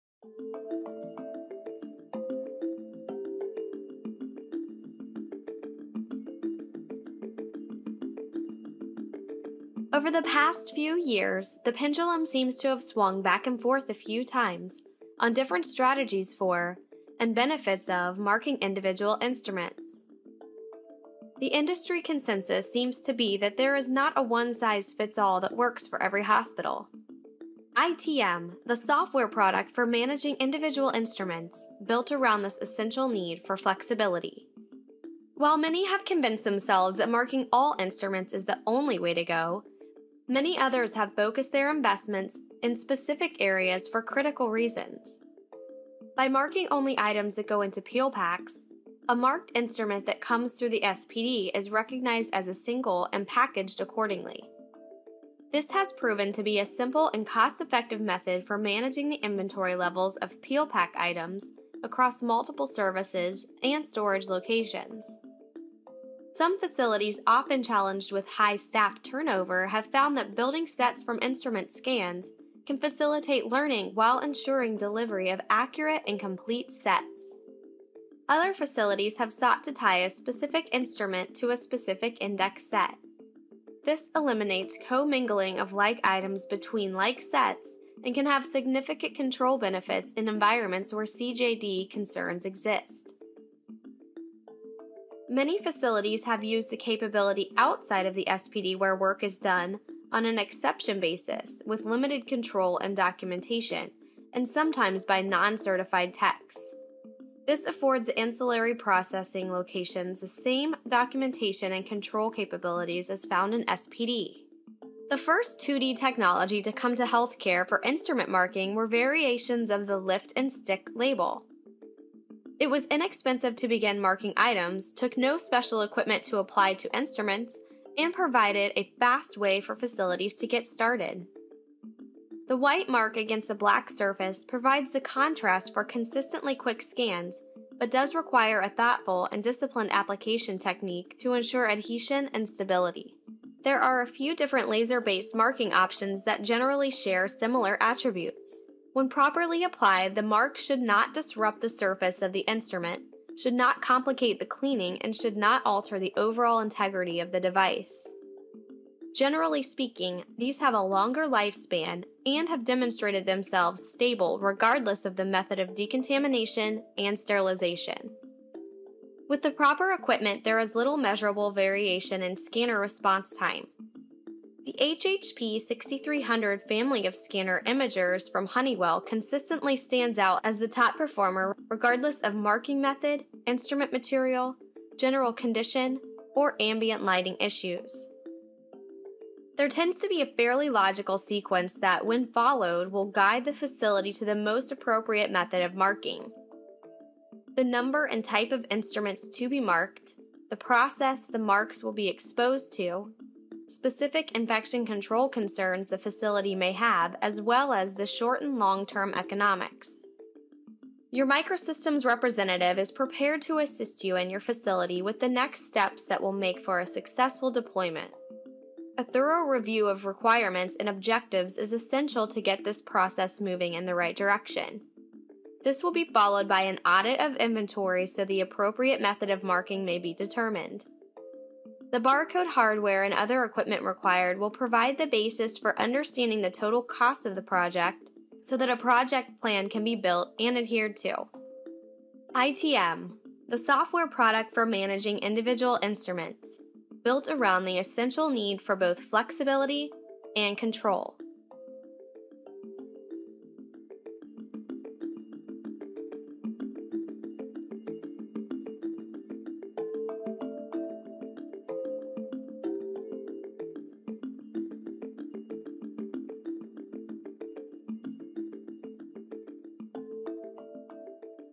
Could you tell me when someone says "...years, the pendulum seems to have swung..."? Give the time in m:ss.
0:10.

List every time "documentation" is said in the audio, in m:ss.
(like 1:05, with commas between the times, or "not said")
1:42, 1:50.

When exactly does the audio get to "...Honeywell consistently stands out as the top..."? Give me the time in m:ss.
2:58.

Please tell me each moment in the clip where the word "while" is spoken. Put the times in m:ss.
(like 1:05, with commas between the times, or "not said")
0:35, 1:13.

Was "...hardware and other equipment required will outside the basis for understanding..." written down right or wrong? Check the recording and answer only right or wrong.
wrong.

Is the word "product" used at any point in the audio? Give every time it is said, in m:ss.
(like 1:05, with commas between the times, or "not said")
0:29, 4:04.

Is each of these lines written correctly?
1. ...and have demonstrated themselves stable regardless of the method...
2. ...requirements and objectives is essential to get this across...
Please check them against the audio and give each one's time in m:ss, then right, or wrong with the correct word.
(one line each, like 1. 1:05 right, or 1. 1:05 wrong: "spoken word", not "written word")
1. 2:42 right
2. 3:40 wrong: "process", not "across".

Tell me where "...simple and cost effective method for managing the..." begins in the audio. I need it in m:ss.
0:56.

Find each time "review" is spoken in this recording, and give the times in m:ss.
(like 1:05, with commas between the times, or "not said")
3:39.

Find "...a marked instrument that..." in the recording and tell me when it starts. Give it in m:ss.
0:49.